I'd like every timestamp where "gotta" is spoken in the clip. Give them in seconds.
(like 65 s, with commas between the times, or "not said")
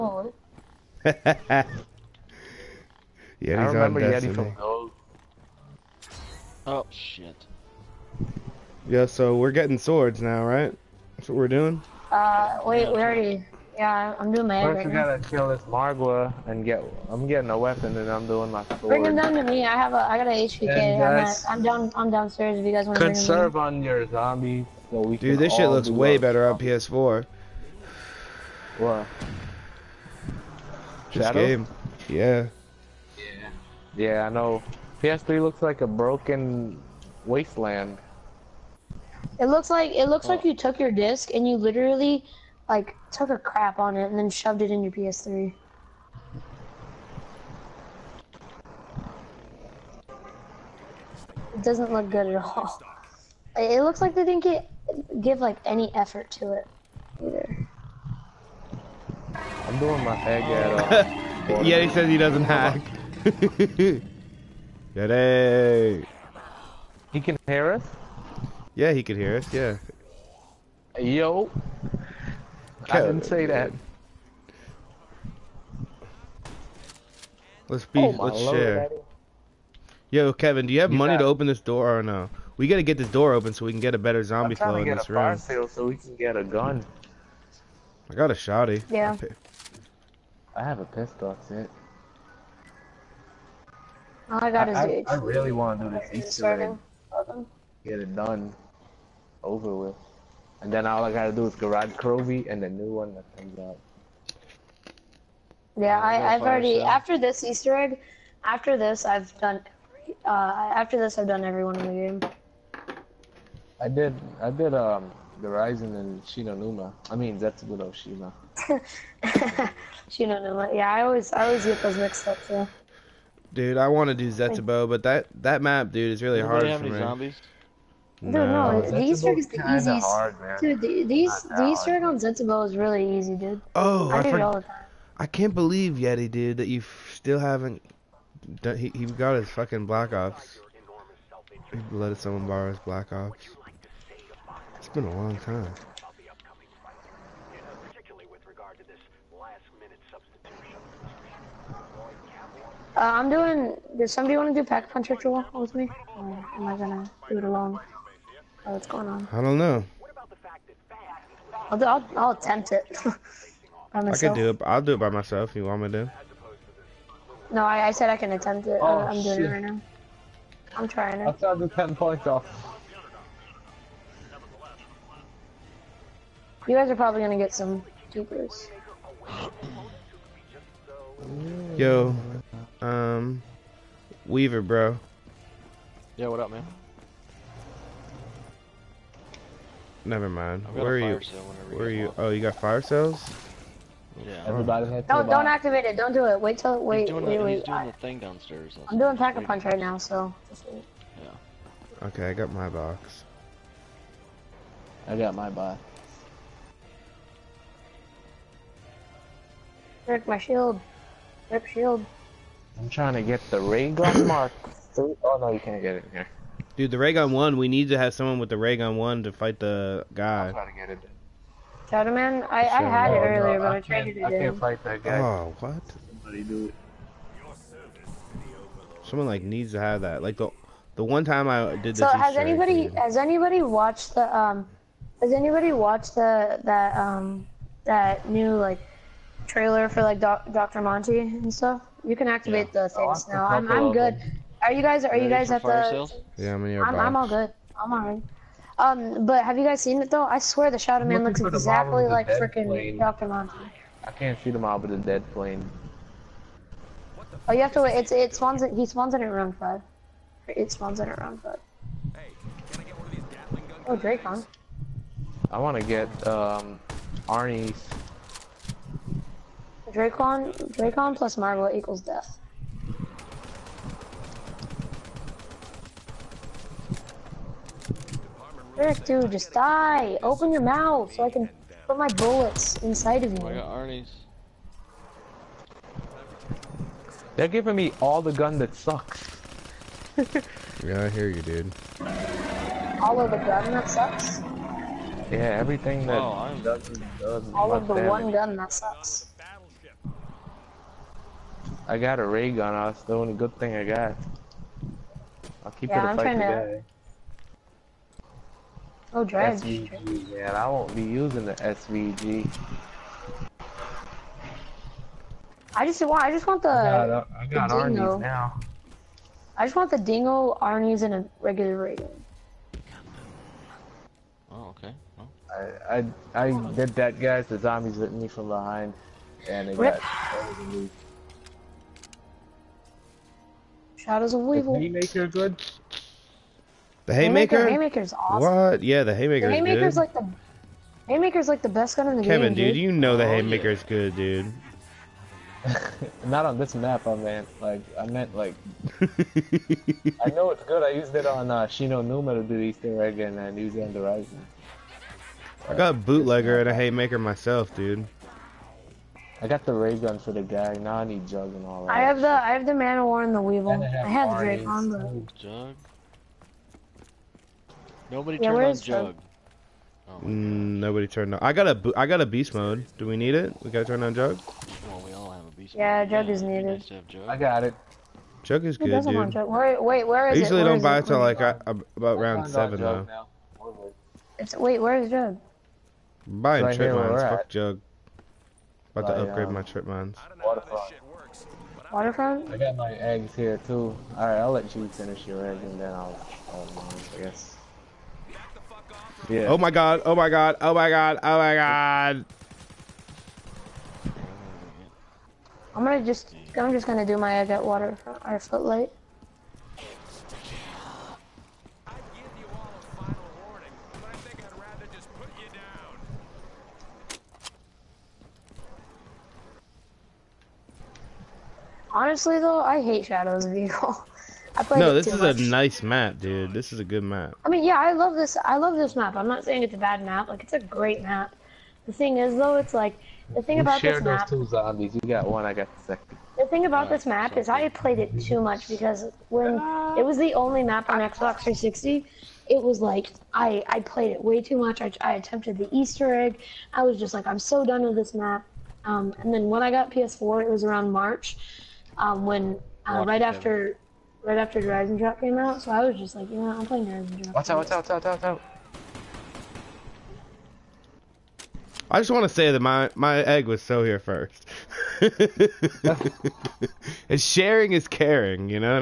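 14 s, 82 s, 101 s, 373 s.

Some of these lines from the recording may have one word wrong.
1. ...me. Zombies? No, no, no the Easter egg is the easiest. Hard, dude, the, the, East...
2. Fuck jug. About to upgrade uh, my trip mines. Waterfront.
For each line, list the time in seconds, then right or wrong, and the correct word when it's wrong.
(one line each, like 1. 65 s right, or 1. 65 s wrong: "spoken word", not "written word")
1. 126 s right
2. 387 s right.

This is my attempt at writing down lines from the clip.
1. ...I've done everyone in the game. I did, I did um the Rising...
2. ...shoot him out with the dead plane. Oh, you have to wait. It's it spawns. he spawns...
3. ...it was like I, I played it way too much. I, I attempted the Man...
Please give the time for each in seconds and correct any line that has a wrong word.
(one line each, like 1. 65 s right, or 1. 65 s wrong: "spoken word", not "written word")
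1. 111 s right
2. 254 s right
3. 442 s wrong: "Easter", not "Man".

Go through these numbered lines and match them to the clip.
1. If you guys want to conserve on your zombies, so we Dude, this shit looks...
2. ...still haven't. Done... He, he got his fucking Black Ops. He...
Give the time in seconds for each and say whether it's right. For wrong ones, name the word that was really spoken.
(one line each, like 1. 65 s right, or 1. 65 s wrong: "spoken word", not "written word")
1. 22 s right
2. 137 s right.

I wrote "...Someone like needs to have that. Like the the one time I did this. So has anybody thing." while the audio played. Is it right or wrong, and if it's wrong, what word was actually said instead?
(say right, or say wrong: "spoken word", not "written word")
right.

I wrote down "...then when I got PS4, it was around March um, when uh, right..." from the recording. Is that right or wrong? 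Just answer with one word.
right.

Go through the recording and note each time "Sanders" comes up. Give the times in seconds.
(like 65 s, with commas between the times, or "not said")
not said.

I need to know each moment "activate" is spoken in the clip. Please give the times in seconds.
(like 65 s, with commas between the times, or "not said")
195 s, 242 s.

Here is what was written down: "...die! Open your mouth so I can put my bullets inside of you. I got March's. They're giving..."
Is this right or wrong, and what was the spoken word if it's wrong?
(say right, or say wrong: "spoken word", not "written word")
wrong: "Arnie", not "March".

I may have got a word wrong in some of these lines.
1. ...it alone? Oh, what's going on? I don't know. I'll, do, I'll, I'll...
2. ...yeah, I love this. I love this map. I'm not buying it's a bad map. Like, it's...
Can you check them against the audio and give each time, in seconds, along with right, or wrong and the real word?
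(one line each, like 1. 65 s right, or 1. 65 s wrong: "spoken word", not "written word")
1. 157 s right
2. 427 s wrong: "saying", not "buying".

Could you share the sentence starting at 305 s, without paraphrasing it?
I'll keep yeah, it a I'm fight trying today.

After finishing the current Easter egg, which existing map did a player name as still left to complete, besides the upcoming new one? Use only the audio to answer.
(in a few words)
Gorod Krovi.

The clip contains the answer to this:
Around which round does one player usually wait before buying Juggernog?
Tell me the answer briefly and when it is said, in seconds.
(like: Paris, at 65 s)
7, at 382 s.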